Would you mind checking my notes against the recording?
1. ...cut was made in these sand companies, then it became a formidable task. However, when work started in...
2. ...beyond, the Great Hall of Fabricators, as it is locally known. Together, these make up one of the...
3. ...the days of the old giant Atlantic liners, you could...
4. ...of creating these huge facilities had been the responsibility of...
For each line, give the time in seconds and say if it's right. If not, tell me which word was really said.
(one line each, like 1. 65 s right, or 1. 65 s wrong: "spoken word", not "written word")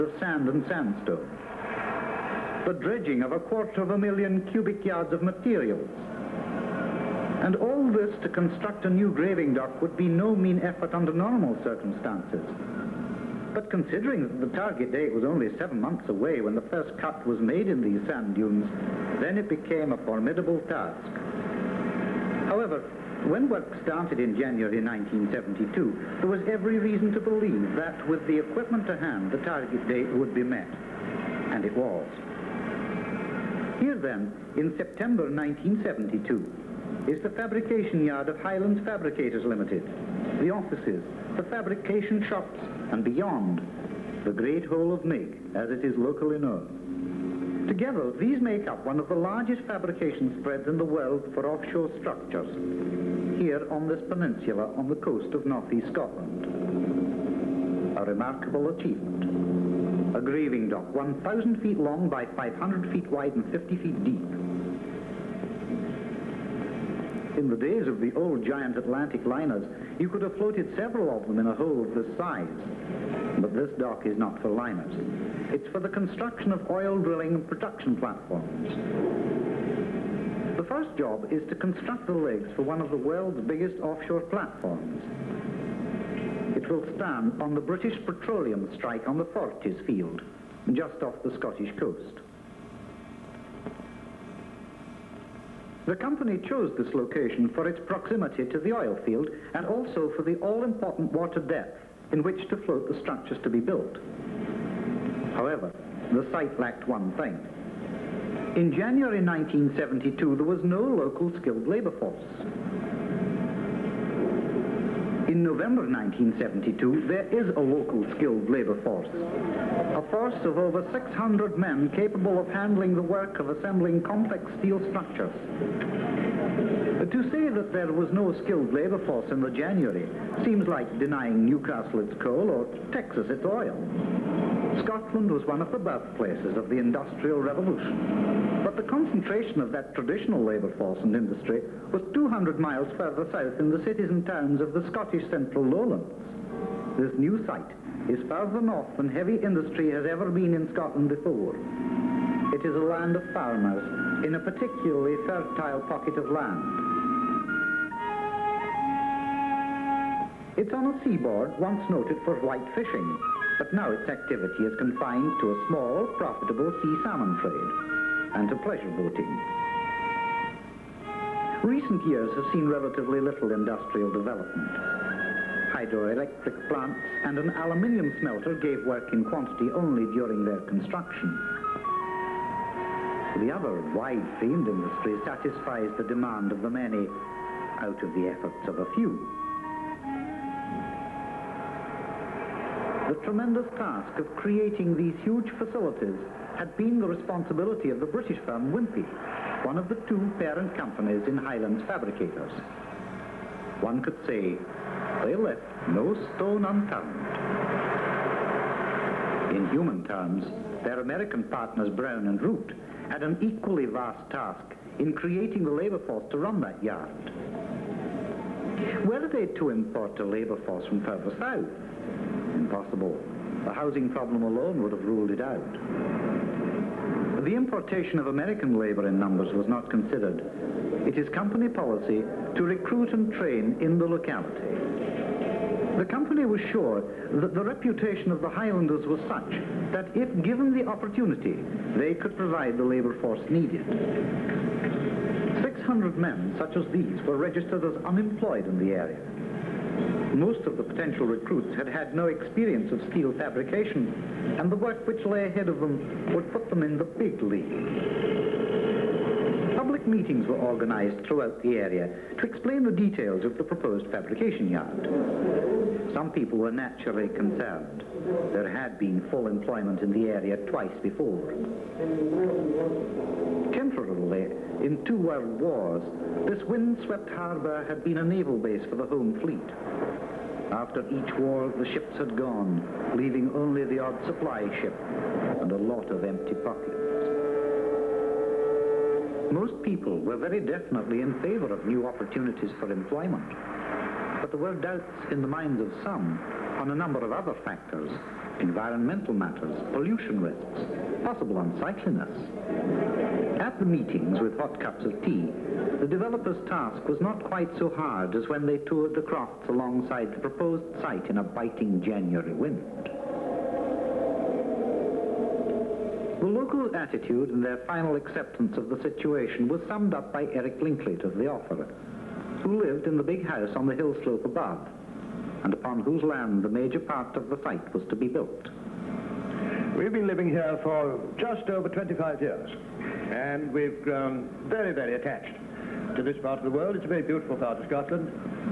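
1. 16 s wrong: "dunes", not "companies"
2. 43 s wrong: "Nigg", not "Fabricators"
3. 67 s right
4. 194 s right.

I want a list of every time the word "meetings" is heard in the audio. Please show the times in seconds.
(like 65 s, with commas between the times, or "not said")
260 s, 303 s.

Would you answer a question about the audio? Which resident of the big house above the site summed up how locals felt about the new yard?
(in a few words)
Eric Linklater.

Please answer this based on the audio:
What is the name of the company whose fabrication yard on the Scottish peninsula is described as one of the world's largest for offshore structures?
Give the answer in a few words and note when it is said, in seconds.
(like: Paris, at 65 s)
Highlands Fabricators Limited, at 38 s.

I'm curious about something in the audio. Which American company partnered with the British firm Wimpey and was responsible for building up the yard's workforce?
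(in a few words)
Brown and Root.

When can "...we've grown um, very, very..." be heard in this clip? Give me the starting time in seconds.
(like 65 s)
333 s.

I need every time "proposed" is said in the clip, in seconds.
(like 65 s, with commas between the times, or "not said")
263 s, 310 s.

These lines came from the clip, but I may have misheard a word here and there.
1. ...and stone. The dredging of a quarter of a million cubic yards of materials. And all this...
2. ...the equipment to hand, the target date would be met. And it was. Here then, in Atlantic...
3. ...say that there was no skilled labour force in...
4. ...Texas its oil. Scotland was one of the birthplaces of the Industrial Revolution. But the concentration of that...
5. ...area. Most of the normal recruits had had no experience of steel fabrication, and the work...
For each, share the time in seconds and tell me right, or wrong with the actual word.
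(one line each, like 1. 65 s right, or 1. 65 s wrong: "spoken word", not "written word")
1. 0 s wrong: "sandstone", not "stone"
2. 28 s wrong: "September", not "Atlantic"
3. 127 s right
4. 132 s right
5. 248 s wrong: "potential", not "normal".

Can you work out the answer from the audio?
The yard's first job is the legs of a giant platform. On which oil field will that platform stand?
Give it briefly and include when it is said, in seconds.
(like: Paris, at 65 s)
Forties field, at 89 s.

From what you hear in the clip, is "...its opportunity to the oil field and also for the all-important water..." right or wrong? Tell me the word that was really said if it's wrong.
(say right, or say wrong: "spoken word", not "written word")
wrong: "proximity", not "opportunity".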